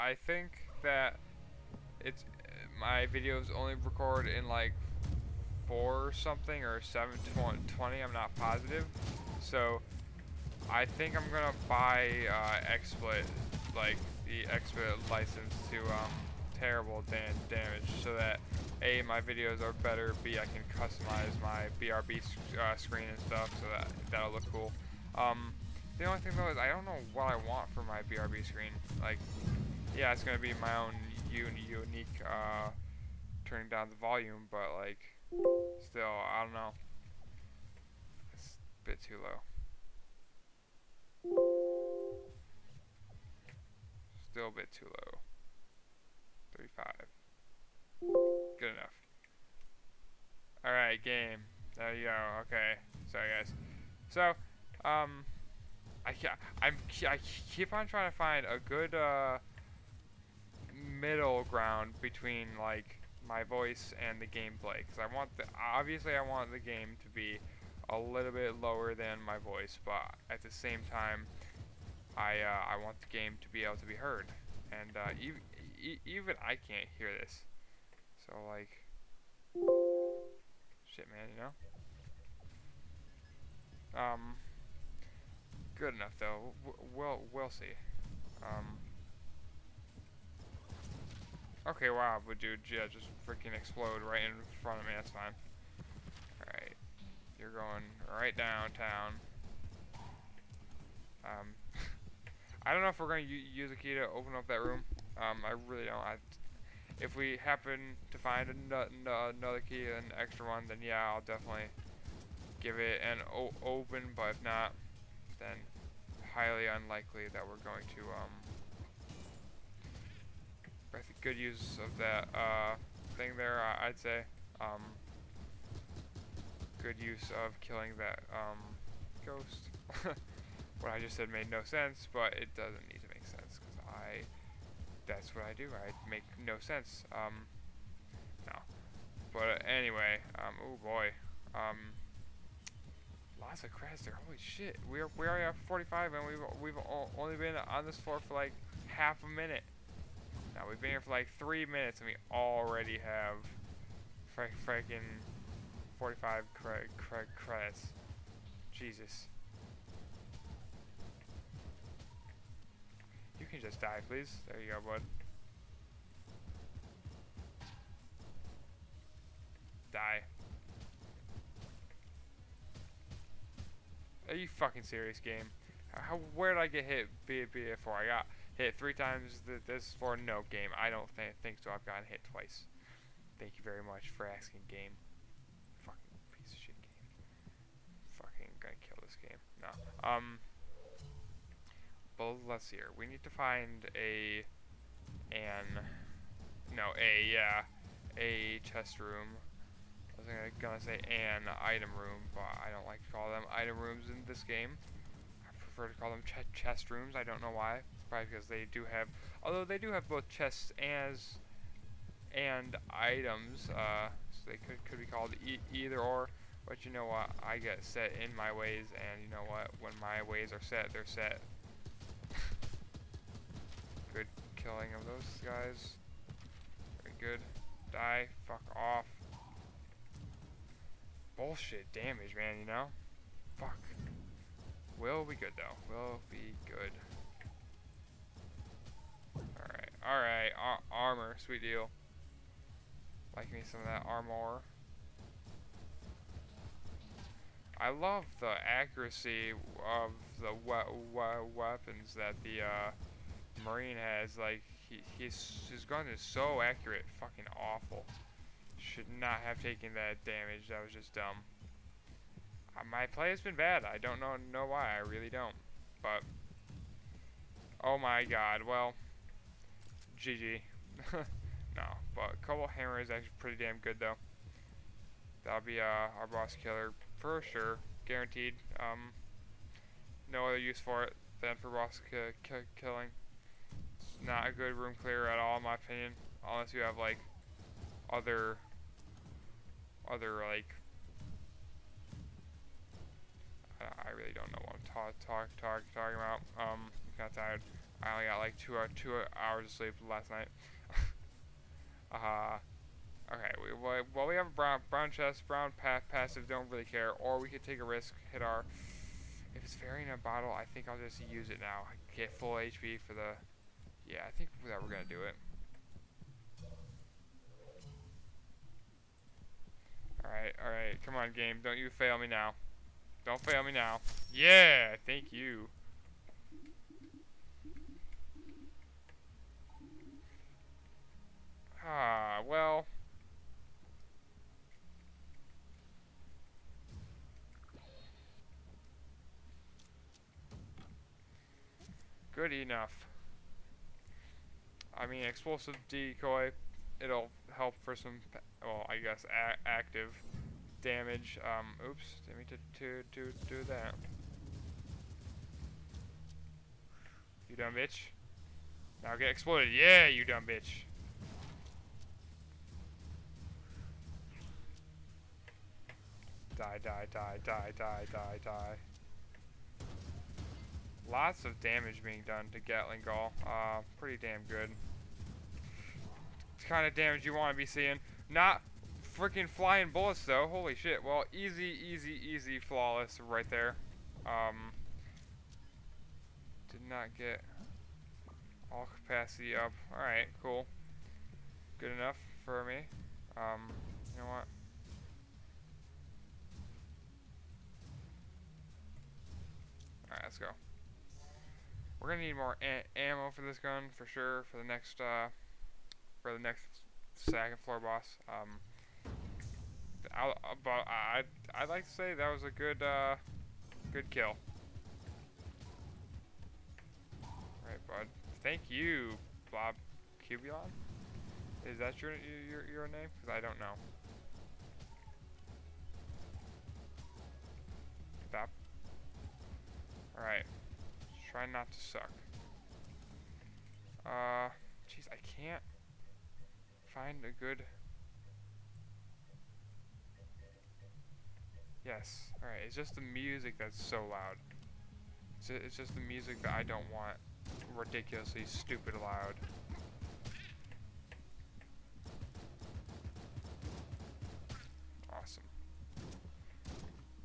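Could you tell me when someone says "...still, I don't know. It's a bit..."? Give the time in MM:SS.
00:35.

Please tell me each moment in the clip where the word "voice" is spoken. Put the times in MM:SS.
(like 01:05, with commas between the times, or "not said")
01:03, 01:09.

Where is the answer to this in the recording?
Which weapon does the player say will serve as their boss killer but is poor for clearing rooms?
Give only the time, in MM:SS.
04:32.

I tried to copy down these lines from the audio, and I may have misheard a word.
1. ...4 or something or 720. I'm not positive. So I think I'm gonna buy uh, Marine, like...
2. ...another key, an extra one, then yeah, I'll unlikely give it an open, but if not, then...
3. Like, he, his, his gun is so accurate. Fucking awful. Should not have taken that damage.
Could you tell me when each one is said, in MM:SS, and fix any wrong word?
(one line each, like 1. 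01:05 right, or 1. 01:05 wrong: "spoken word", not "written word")
1. 00:05 wrong: "XSplit", not "Marine"
2. 01:48 wrong: "definitely", not "unlikely"
3. 04:14 right.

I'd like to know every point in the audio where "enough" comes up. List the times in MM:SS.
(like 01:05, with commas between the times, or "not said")
00:48, 01:25, 05:42, 06:31.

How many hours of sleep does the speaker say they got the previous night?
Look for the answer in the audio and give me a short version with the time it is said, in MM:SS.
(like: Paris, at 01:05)
2, at 04:58.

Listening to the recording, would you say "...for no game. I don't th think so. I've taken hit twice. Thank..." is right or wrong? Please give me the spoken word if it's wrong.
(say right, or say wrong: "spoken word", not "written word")
wrong: "gotten", not "taken".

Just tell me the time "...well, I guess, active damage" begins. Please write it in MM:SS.
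05:48.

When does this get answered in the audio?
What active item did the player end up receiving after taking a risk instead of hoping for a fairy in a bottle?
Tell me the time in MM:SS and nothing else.
05:45.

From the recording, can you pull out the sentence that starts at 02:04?
Um, good use of killing that um, ghost.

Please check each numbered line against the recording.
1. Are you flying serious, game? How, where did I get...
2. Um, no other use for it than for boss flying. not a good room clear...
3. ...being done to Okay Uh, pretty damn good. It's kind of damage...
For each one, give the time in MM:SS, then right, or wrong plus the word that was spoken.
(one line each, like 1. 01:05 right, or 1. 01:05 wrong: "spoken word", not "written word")
1. 02:54 wrong: "fucking", not "flying"
2. 04:38 wrong: "killing", not "flying"
3. 06:12 wrong: "Gatling", not "Okay".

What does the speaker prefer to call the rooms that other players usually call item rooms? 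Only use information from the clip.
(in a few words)
chest rooms.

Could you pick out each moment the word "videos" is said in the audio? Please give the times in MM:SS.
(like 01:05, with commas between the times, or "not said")
00:03, 00:19.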